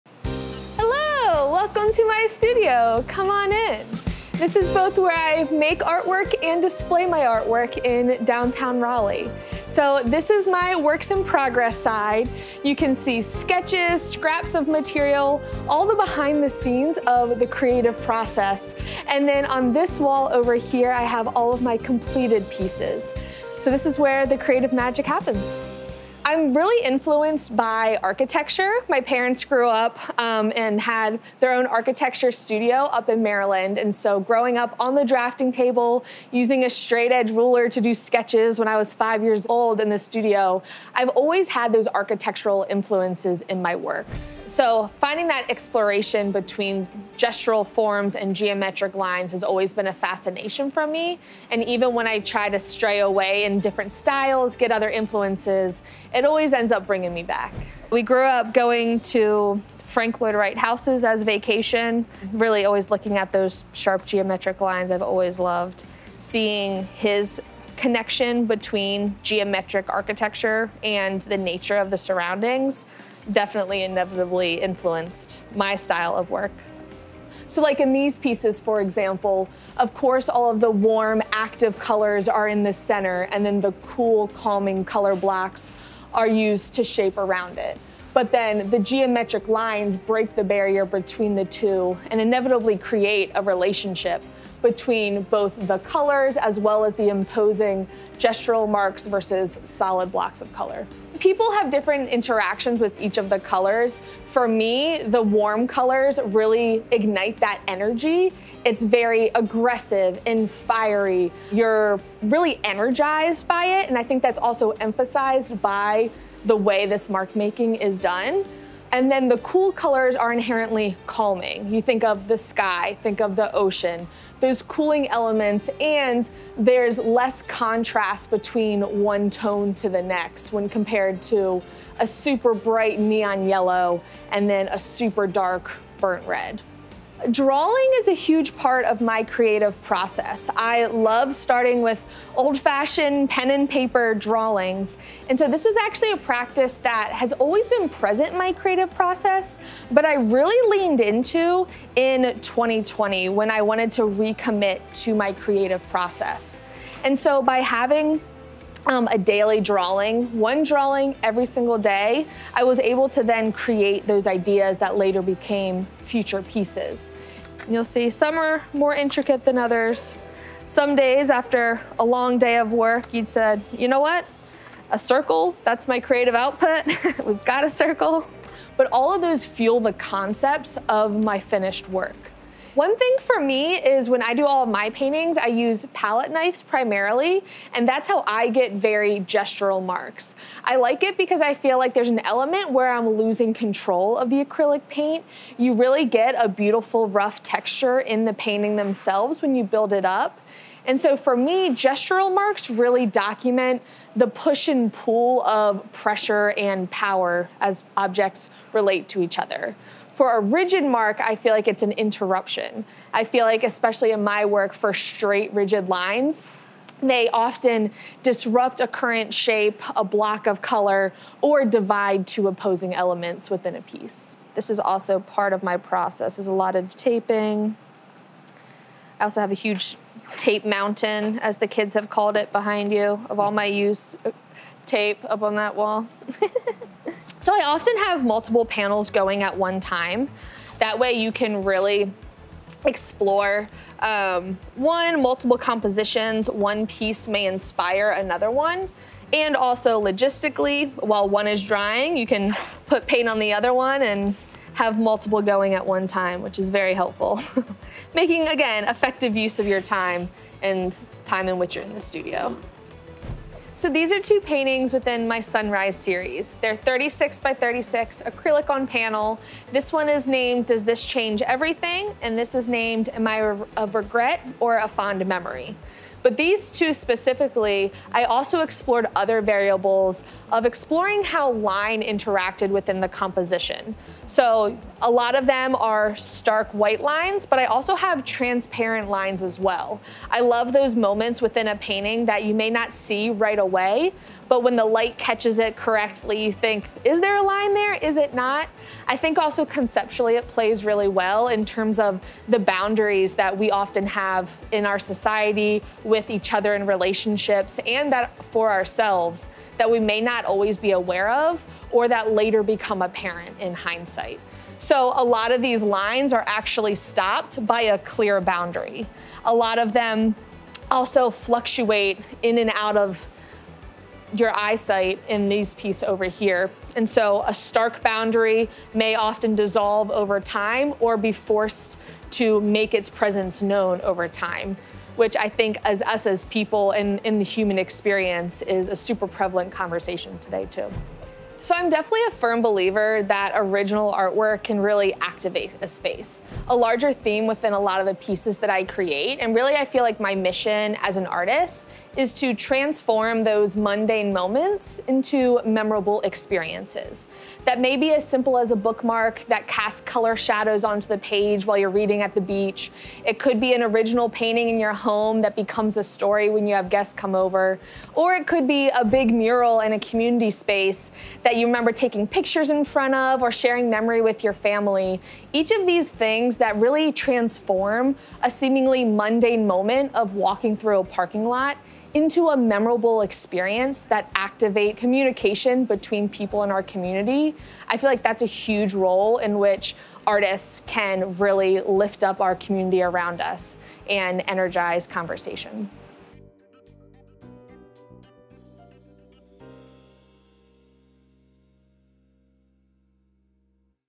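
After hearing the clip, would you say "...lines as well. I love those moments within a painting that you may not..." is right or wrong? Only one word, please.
right.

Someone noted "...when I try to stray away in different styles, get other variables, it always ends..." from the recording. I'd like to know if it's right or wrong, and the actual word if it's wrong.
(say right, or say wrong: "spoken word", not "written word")
wrong: "influences", not "variables".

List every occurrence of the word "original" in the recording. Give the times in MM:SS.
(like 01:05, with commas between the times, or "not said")
05:43, 06:03.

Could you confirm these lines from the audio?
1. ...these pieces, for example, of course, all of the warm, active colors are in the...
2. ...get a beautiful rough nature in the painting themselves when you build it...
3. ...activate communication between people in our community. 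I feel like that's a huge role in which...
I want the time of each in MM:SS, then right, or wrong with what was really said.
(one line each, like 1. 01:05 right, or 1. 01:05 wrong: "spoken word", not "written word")
1. 01:17 right
2. 03:16 wrong: "texture", not "nature"
3. 06:24 right.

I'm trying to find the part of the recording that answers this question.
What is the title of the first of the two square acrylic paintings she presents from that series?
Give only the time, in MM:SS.
04:30.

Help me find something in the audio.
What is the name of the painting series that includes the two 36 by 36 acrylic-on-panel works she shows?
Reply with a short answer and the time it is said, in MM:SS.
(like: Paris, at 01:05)
Sunrise, at 04:25.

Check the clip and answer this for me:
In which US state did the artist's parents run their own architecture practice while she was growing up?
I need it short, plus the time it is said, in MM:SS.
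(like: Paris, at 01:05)
Maryland, at 00:33.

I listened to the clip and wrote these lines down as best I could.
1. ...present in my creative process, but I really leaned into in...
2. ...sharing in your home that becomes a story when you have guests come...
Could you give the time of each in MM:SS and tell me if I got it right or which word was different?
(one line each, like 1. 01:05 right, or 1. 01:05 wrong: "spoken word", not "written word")
1. 02:27 right
2. 06:04 wrong: "painting", not "sharing".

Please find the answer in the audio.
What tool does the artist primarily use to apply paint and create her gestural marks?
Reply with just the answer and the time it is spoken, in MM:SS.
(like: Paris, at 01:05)
Palette knives, at 03:05.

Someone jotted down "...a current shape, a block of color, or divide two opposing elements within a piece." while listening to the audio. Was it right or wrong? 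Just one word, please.
right.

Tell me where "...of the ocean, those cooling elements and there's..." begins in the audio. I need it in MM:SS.
02:03.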